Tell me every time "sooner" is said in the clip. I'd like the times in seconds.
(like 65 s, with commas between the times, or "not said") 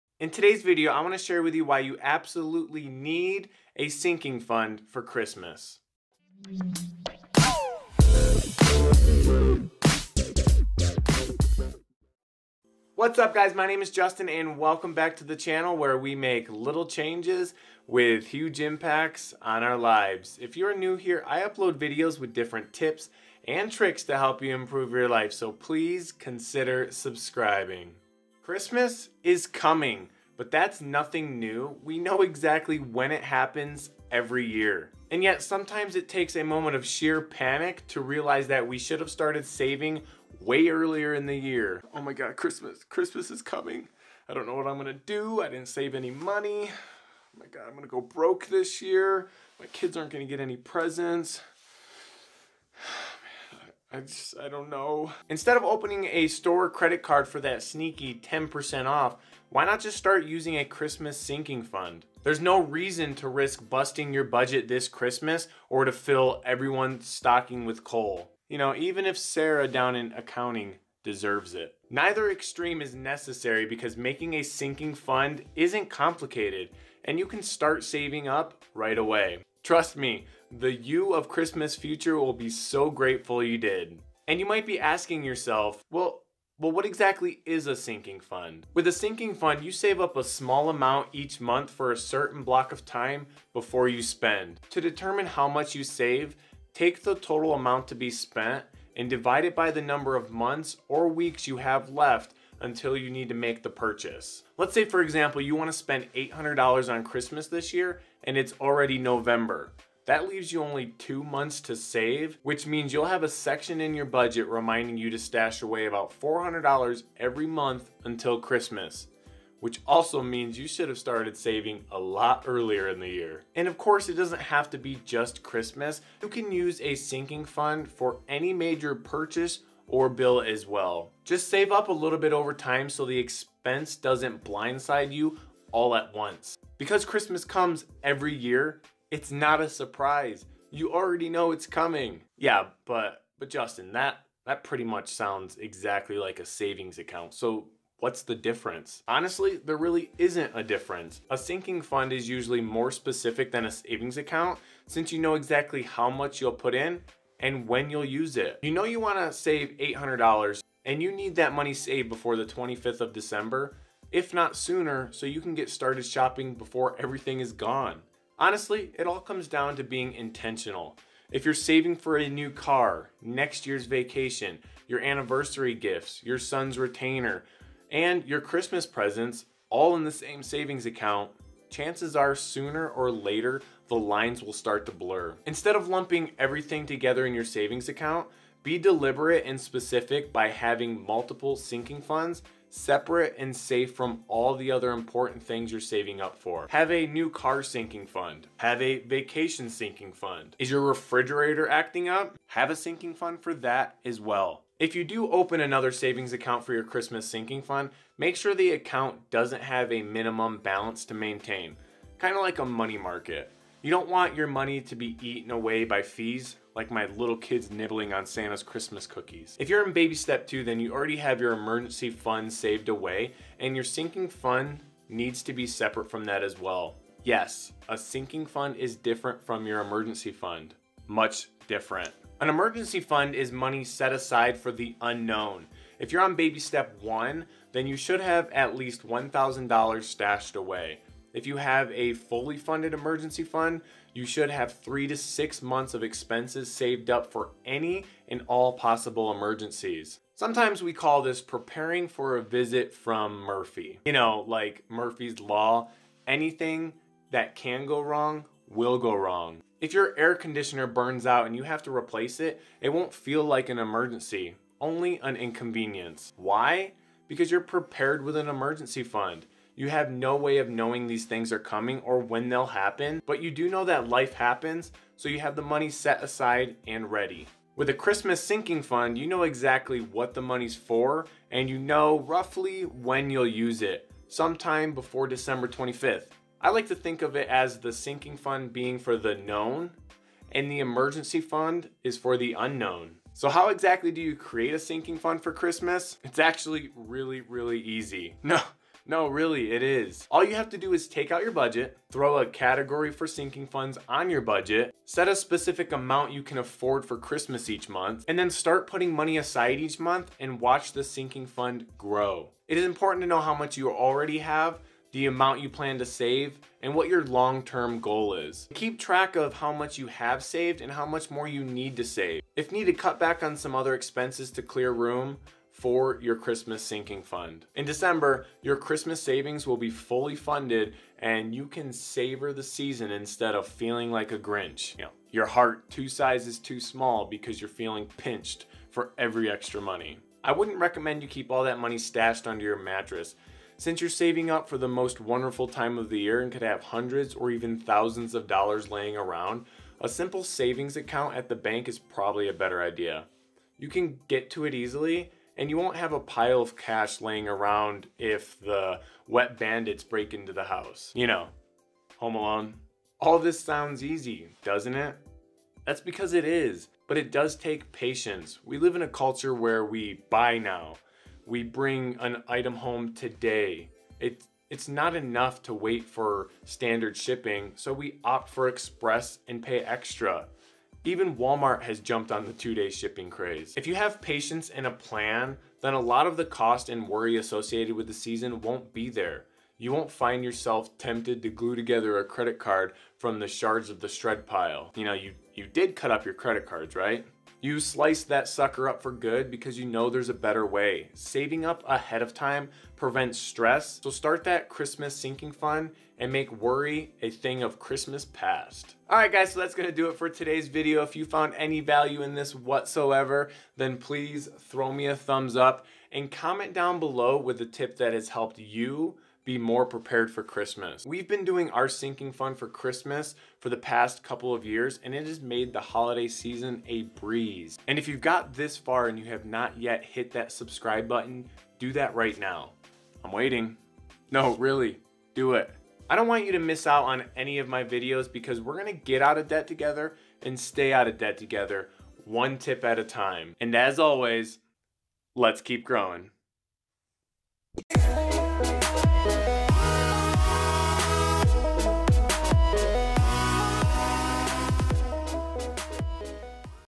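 164 s, 182 s.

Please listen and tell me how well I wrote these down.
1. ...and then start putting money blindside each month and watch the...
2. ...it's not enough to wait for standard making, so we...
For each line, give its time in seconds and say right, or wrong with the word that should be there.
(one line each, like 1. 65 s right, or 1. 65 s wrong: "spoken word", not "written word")
1. 308 s wrong: "aside", not "blindside"
2. 374 s wrong: "shipping", not "making".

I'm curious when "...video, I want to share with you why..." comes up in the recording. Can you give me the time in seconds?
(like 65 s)
0 s.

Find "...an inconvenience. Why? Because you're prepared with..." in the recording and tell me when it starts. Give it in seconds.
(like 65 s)
265 s.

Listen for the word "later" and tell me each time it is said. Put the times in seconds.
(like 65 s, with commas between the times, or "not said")
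183 s.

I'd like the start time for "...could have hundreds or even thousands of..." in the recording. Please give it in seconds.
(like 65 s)
346 s.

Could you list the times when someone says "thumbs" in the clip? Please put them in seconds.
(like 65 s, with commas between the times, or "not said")
415 s.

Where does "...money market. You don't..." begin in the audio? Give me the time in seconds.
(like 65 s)
212 s.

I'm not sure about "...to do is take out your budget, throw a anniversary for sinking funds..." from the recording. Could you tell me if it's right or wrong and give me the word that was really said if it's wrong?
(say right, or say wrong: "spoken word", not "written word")
wrong: "category", not "anniversary".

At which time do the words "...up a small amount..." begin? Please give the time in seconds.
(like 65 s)
90 s.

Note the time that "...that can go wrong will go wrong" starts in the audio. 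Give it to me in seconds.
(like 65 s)
257 s.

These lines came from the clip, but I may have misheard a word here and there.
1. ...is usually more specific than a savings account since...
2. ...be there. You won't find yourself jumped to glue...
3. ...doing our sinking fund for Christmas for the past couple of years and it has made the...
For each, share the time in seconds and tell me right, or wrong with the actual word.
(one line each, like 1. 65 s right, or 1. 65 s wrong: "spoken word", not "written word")
1. 152 s right
2. 388 s wrong: "tempted", not "jumped"
3. 421 s right.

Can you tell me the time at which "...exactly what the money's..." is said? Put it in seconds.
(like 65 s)
279 s.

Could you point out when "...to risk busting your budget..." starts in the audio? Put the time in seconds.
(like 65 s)
63 s.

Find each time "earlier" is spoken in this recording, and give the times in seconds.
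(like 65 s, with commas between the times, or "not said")
40 s, 122 s.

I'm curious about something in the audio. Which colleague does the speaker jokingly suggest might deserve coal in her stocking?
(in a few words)
Sarah.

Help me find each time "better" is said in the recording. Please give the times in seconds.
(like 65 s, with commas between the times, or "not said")
352 s, 400 s.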